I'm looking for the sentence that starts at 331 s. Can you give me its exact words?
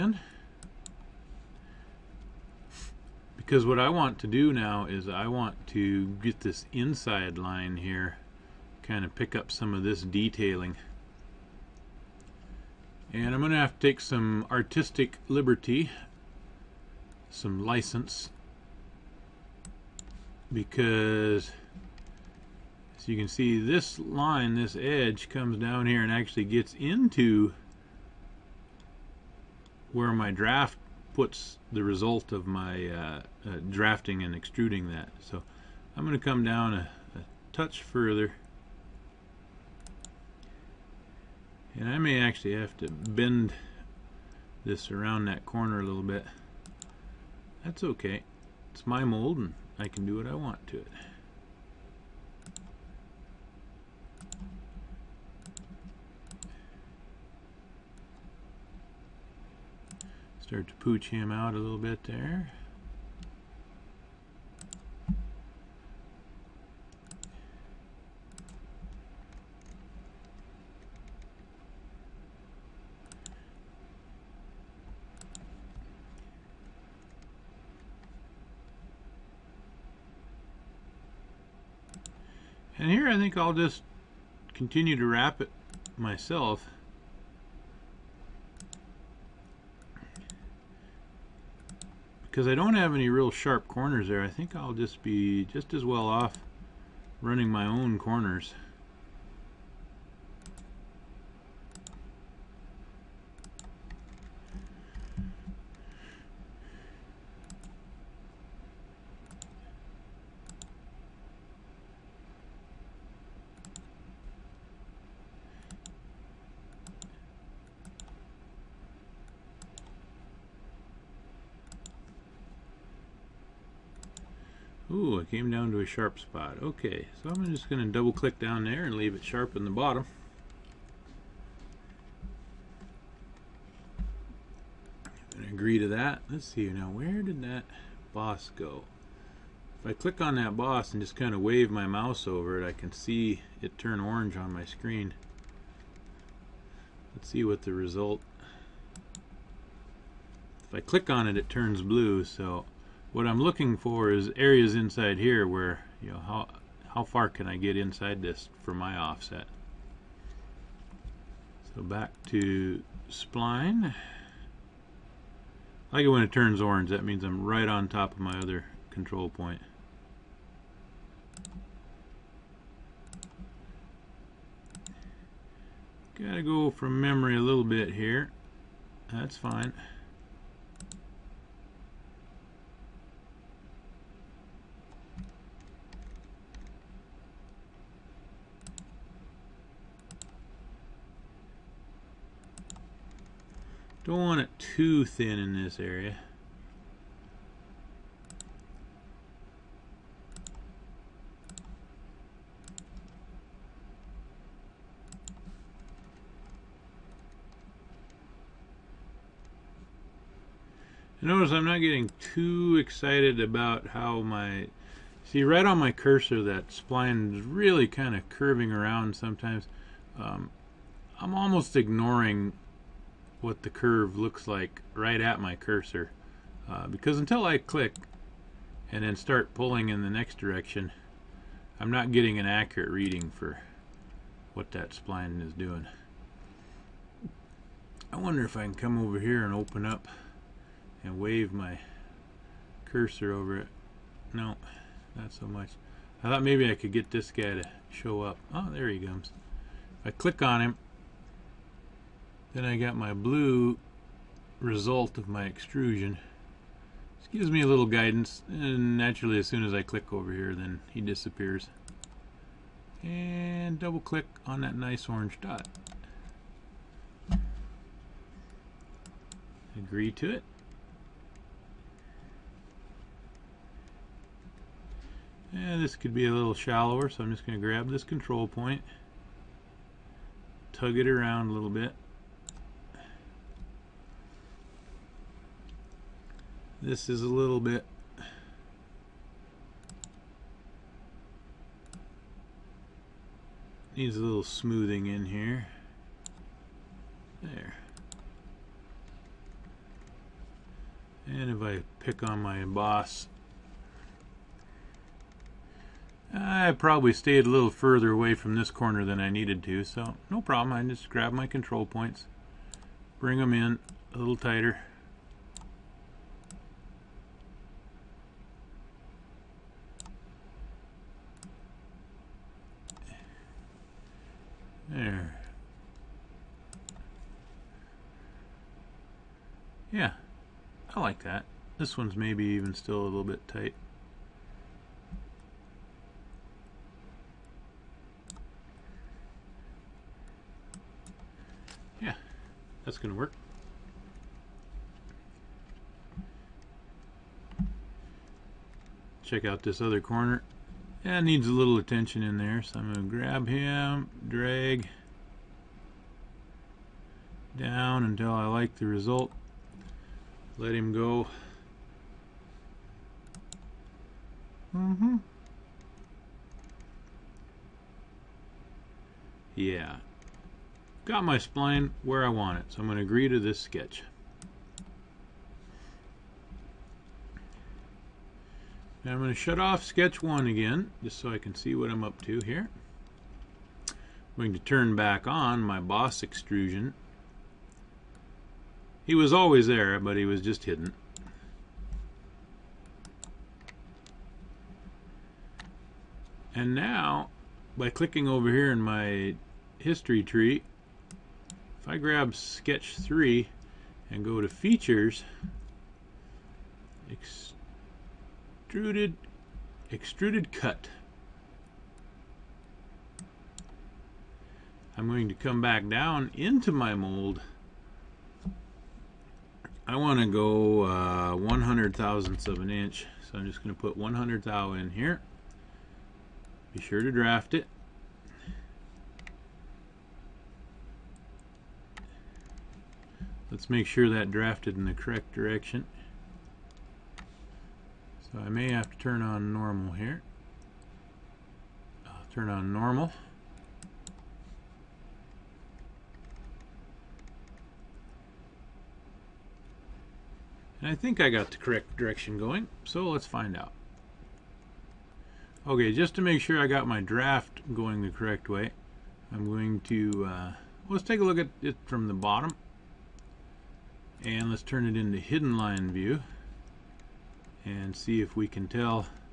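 This one's maybe even still a little bit tight.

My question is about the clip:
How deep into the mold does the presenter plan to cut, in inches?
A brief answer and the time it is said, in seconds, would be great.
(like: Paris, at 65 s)
0.100 inch, at 421 s.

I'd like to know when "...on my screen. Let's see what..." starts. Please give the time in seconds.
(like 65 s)
144 s.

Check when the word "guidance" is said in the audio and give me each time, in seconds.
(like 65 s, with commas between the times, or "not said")
257 s.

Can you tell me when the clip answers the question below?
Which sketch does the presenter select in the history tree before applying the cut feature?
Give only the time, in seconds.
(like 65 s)
402 s.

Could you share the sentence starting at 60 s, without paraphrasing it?
Start to pooch him out a little bit there.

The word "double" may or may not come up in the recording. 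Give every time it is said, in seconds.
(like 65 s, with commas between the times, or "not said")
127 s, 263 s.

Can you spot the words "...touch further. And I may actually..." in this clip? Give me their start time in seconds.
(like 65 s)
37 s.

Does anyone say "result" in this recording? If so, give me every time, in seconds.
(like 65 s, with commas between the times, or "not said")
31 s, 147 s, 254 s, 358 s.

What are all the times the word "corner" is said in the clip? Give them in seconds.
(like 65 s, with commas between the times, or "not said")
45 s, 93 s, 97 s, 308 s, 350 s.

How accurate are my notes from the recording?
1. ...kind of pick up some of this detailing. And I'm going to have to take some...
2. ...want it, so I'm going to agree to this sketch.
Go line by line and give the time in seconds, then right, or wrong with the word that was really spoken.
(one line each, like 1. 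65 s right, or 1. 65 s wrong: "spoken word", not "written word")
1. 8 s right
2. 372 s right.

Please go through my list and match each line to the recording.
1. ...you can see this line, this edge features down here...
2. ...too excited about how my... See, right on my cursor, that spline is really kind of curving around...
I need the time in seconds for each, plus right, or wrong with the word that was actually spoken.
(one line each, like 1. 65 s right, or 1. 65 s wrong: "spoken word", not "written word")
1. 23 s wrong: "comes", not "features"
2. 212 s right.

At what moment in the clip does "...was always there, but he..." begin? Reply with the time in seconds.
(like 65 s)
389 s.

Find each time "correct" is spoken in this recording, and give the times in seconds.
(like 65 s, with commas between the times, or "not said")
434 s, 451 s, 458 s.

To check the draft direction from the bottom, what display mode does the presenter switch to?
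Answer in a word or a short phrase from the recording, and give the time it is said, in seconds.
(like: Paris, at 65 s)
Hidden line view, at 465 s.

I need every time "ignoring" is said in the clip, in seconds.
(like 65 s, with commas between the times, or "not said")
221 s.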